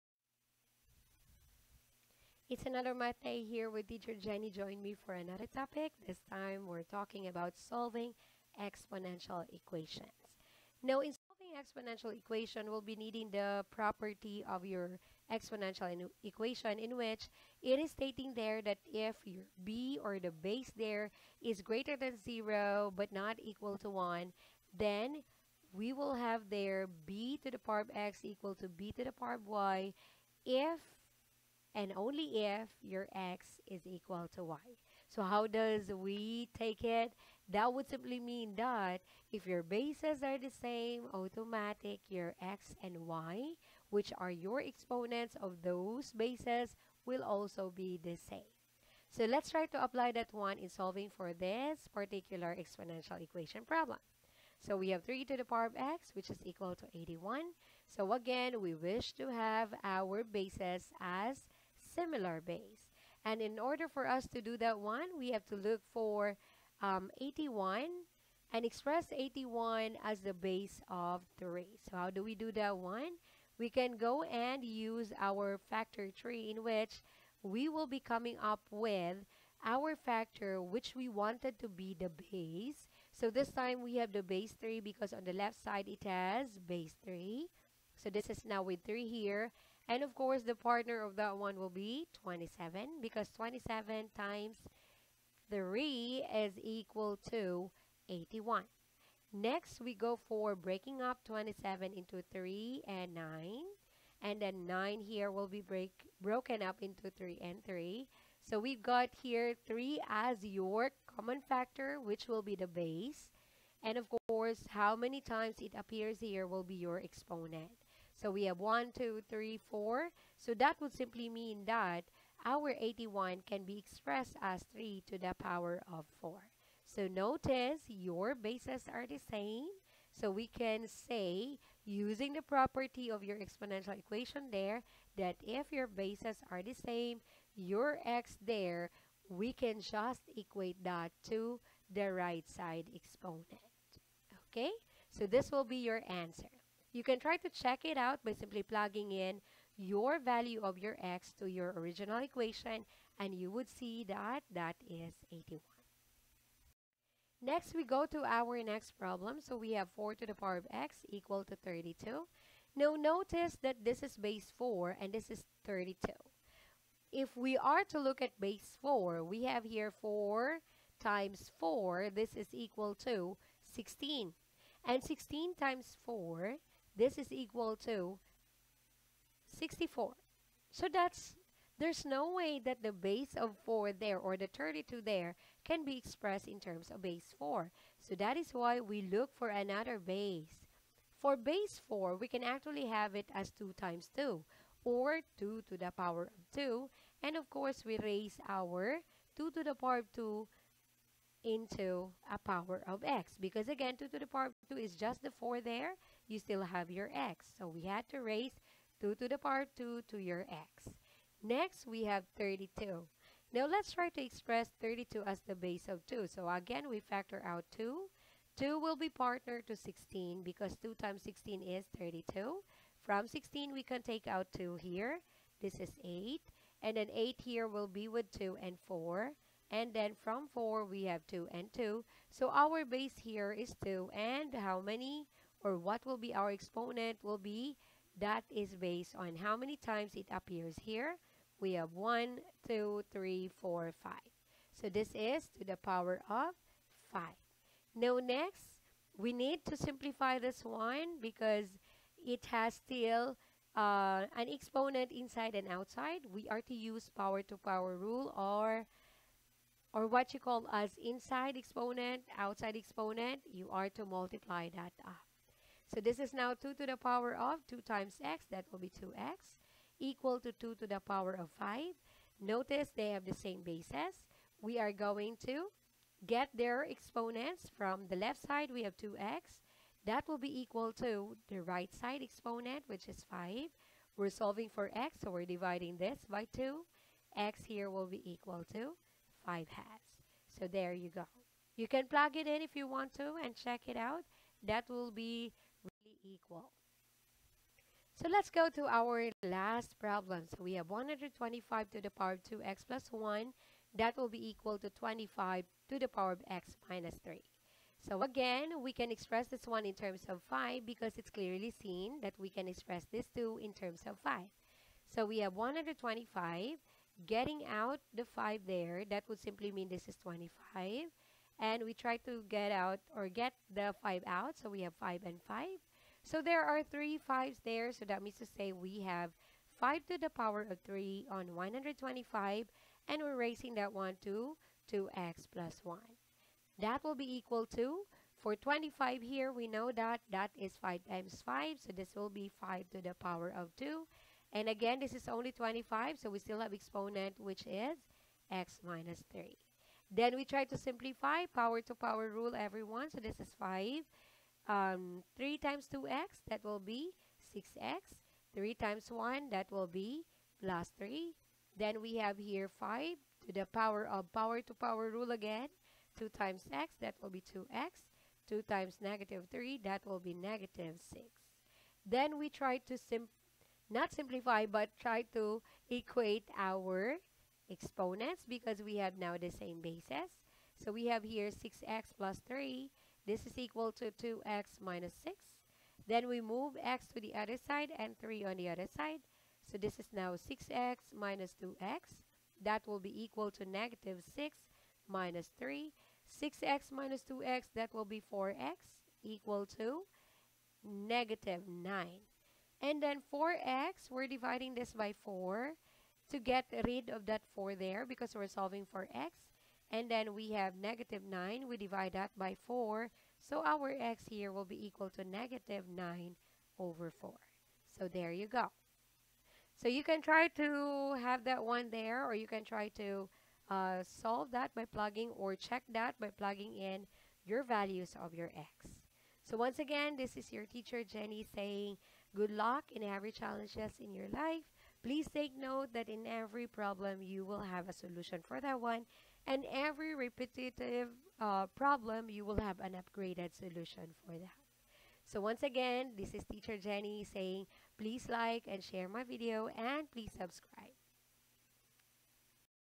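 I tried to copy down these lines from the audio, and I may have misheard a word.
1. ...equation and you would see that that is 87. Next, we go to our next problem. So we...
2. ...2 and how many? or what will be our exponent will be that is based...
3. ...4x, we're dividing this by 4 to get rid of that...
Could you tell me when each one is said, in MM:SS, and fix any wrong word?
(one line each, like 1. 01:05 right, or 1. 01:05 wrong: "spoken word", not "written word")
1. 02:32 wrong: "81", not "87"
2. 03:53 right
3. 06:43 right.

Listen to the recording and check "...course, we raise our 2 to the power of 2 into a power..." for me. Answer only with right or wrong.
right.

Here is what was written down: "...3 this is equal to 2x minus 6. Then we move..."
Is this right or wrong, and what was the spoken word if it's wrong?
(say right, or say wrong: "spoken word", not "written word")
right.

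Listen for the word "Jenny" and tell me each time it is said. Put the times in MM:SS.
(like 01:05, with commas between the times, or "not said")
00:04, 07:11, 07:26.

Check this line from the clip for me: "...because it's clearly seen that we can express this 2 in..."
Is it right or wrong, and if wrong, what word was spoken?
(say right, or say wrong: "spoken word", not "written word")
right.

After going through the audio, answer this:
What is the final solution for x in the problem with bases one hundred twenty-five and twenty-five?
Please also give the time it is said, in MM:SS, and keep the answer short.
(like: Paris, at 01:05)
-9/4, at 06:55.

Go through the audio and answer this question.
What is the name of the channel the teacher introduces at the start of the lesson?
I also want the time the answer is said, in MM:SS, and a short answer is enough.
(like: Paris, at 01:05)
ALL-MATH, at 00:02.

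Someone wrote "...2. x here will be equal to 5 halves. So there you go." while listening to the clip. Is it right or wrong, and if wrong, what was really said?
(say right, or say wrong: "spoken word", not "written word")
right.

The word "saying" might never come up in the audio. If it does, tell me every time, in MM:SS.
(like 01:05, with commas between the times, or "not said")
07:11, 07:27.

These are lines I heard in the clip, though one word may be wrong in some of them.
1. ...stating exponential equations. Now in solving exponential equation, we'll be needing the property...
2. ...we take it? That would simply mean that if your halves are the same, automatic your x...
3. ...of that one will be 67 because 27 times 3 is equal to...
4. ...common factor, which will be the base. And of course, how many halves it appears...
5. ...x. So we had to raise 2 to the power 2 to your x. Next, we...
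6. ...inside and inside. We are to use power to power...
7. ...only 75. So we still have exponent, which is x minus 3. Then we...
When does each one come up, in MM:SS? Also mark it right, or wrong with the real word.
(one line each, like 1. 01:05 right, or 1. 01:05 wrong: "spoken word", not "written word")
1. 00:07 wrong: "solving", not "stating"
2. 00:35 wrong: "bases", not "halves"
3. 01:31 wrong: "27", not "67"
4. 01:51 wrong: "times", not "halves"
5. 03:27 right
6. 04:15 wrong: "outside", not "inside"
7. 05:45 wrong: "25", not "75".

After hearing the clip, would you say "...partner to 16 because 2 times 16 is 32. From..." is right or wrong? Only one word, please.
right.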